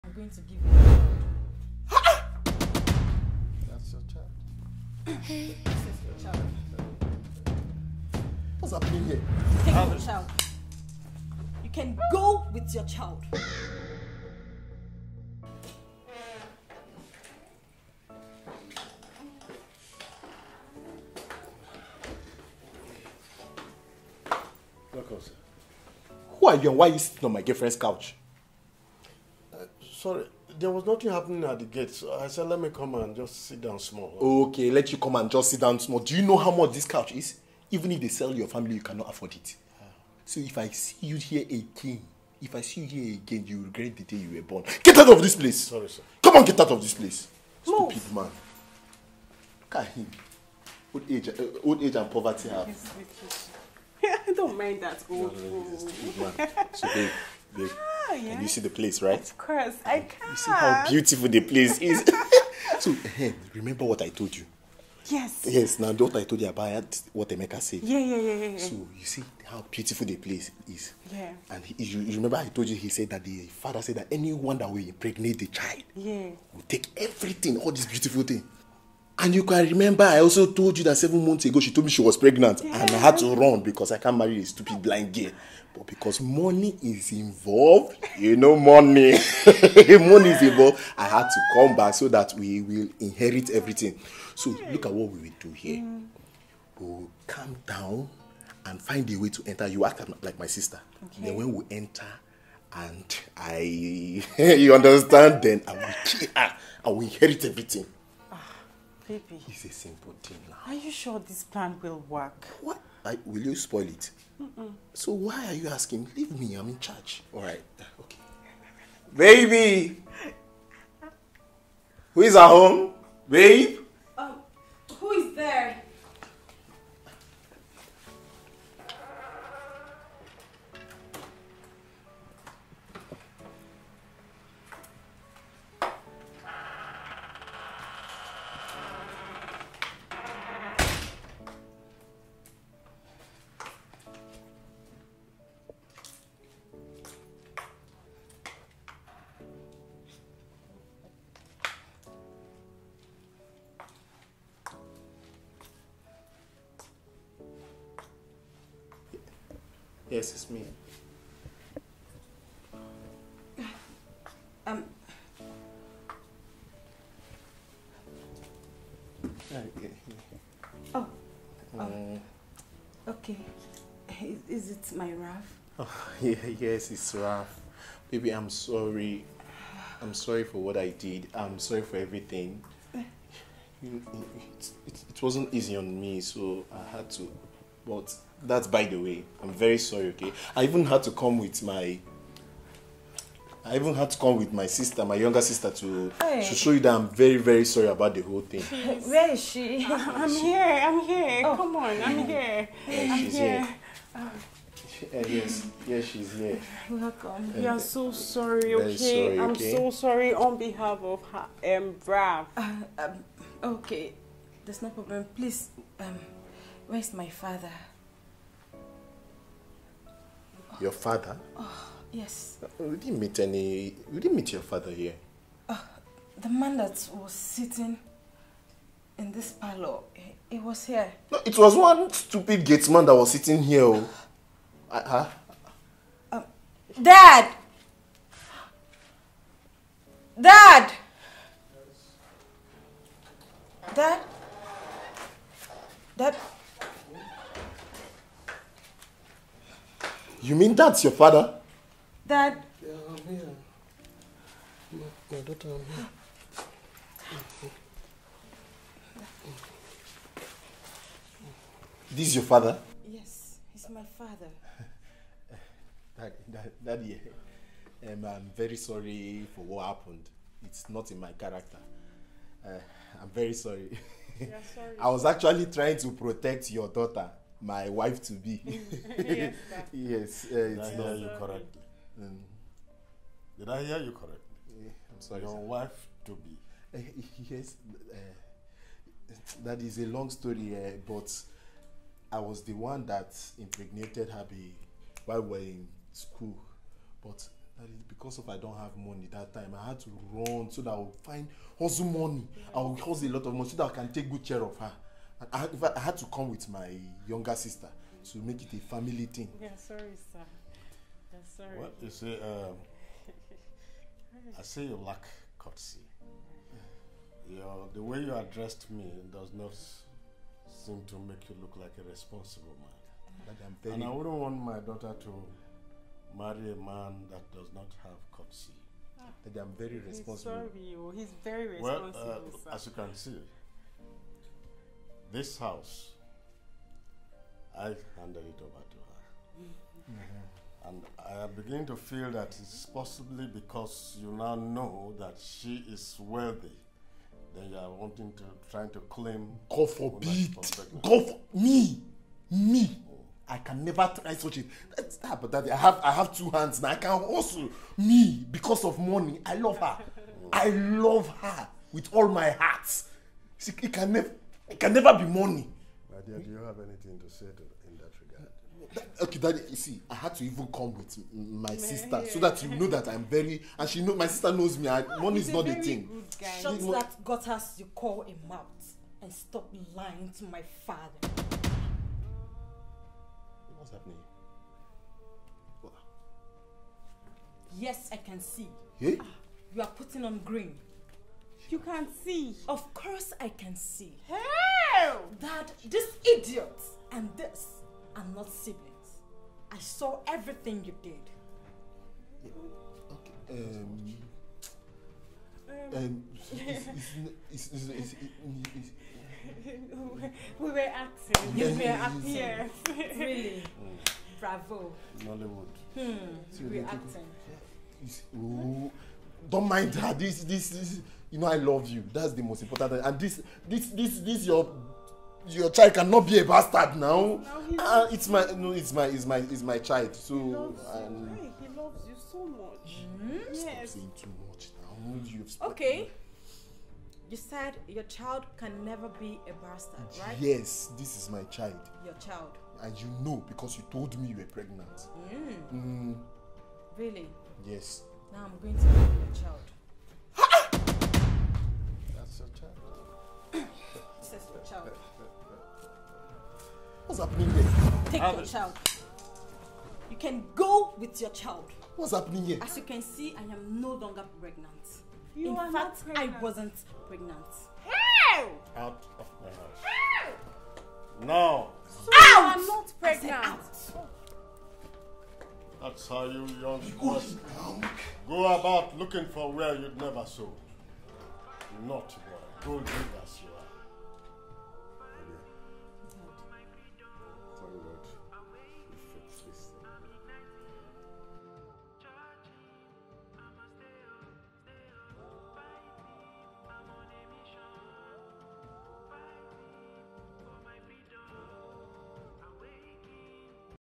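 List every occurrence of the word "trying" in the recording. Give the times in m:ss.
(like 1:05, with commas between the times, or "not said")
4:35, 5:48.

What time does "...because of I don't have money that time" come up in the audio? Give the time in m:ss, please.
4:58.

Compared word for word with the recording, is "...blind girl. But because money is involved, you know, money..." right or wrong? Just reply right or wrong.
right.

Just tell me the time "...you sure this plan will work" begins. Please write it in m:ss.
1:50.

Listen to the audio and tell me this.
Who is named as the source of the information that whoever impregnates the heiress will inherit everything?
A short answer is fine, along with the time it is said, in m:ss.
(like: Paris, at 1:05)
Emeka, at 1:07.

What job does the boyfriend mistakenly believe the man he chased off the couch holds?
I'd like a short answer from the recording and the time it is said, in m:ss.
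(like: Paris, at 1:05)
Gatesman, at 3:52.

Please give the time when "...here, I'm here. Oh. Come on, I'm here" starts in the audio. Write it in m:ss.
3:20.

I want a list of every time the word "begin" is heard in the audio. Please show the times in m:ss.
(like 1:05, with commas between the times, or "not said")
5:41.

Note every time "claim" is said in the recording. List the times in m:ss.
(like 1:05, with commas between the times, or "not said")
5:49.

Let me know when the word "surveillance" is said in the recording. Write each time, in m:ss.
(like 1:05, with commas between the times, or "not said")
not said.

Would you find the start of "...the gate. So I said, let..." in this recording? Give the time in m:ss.
0:31.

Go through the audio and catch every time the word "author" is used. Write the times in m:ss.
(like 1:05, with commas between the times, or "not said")
not said.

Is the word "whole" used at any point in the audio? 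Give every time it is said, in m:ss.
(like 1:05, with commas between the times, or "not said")
3:18.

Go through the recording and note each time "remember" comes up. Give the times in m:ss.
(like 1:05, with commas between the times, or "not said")
1:03, 1:12, 1:19.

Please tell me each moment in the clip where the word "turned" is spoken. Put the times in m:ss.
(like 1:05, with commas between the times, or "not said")
not said.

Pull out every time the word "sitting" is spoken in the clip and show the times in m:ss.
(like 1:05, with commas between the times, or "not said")
0:26, 3:47, 3:53.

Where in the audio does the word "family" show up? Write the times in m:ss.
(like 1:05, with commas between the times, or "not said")
0:38, 5:08.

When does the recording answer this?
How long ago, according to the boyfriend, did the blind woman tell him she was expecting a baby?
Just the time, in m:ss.
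1:20.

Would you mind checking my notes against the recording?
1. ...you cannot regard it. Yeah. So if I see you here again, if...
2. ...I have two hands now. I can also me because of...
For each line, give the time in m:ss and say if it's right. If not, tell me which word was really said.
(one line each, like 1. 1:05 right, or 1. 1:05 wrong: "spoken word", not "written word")
1. 0:38 wrong: "afford", not "regard"
2. 5:56 right.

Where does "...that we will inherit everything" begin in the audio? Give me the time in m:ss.
1:32.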